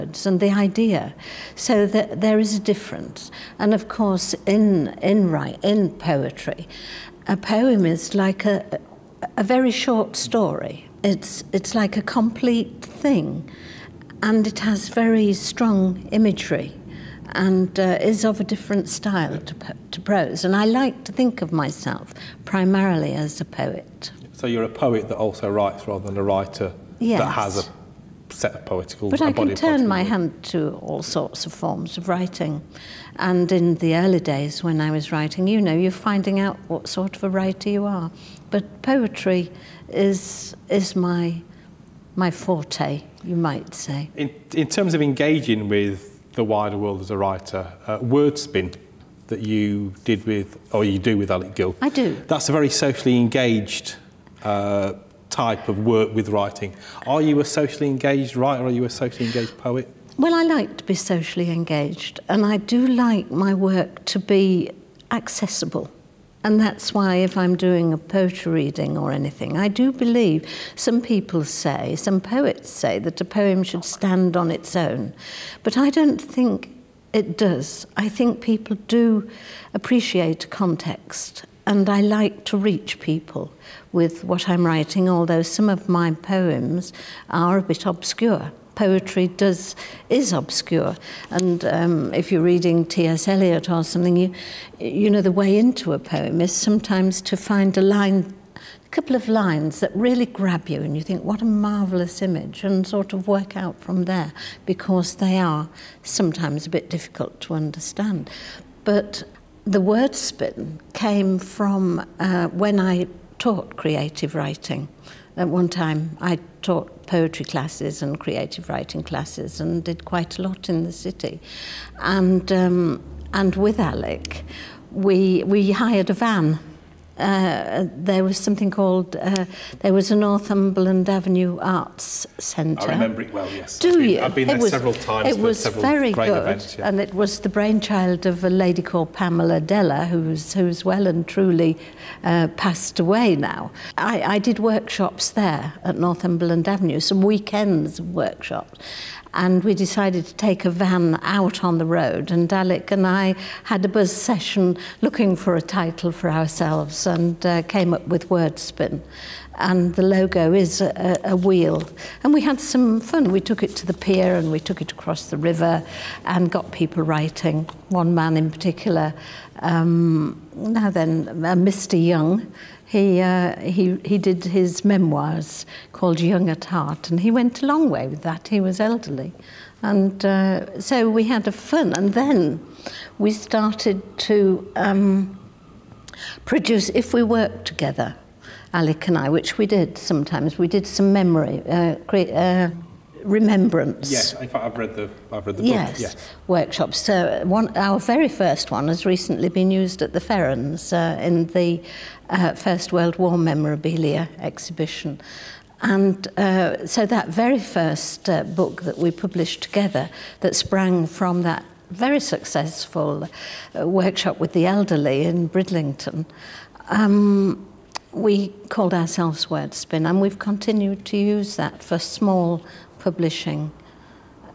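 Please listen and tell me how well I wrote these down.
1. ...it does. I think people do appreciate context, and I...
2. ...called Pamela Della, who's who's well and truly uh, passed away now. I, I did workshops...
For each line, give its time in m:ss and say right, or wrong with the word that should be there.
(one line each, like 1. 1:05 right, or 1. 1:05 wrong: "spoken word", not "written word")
1. 1:17 right
2. 2:18 right.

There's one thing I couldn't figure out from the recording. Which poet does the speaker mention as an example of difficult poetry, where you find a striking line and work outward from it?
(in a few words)
T.S. Eliot.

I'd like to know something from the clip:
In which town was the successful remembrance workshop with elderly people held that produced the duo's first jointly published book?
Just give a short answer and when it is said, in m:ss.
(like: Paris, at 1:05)
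Bridlington, at 3:35.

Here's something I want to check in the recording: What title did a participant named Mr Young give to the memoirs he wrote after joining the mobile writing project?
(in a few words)
Young at Heart.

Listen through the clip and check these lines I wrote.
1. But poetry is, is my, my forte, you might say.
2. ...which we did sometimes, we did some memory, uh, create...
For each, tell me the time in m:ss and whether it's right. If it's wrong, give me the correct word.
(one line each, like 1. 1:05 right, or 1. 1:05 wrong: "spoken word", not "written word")
1. 0:38 right
2. 3:09 right.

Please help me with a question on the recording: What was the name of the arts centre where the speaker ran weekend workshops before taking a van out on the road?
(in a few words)
Northumberland Avenue Arts Centre.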